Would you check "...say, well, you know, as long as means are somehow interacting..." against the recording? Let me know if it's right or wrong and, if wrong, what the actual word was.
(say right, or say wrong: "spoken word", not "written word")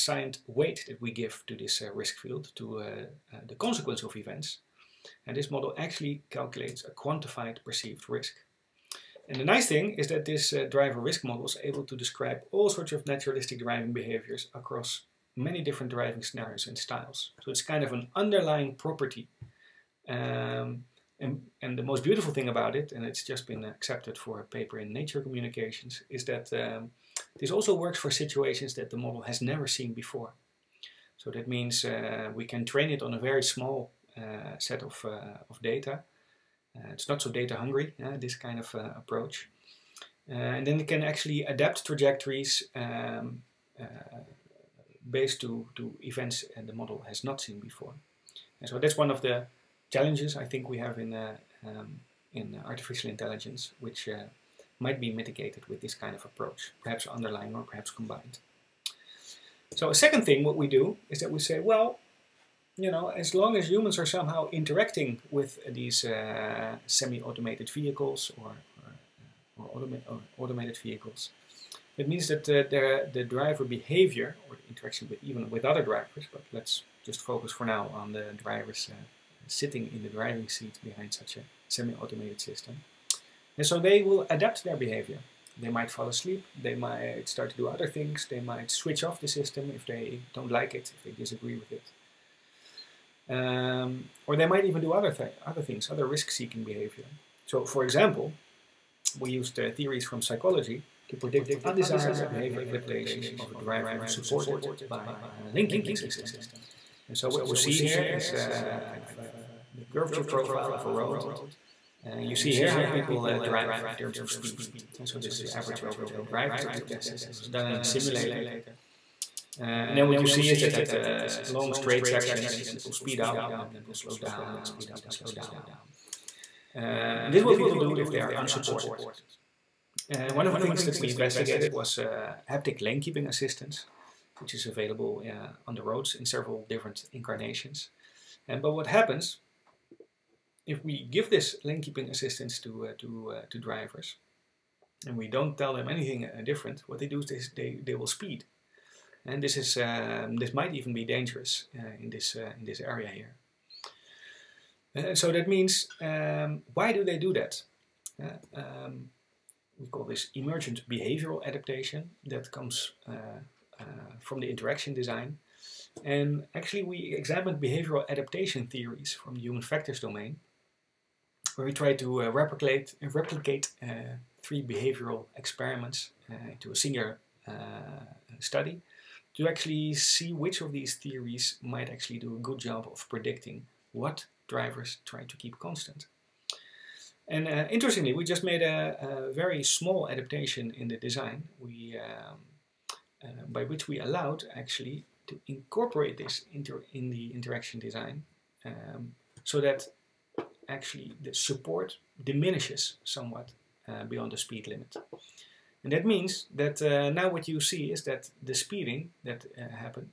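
wrong: "humans", not "means".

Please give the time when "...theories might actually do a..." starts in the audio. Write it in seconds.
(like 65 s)
180 s.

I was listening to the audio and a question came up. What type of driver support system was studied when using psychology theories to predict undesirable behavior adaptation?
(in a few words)
lane keeping system.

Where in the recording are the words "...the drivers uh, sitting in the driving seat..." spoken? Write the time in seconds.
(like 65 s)
78 s.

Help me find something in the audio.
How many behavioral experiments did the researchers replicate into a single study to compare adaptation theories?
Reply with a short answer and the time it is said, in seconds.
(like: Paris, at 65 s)
3, at 174 s.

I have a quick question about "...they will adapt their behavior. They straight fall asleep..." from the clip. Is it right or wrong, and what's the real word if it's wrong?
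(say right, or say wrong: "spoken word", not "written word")
wrong: "might", not "straight".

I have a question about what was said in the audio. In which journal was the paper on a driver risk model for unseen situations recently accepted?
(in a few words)
Nature Communications.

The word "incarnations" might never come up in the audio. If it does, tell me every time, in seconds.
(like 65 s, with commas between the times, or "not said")
137 s.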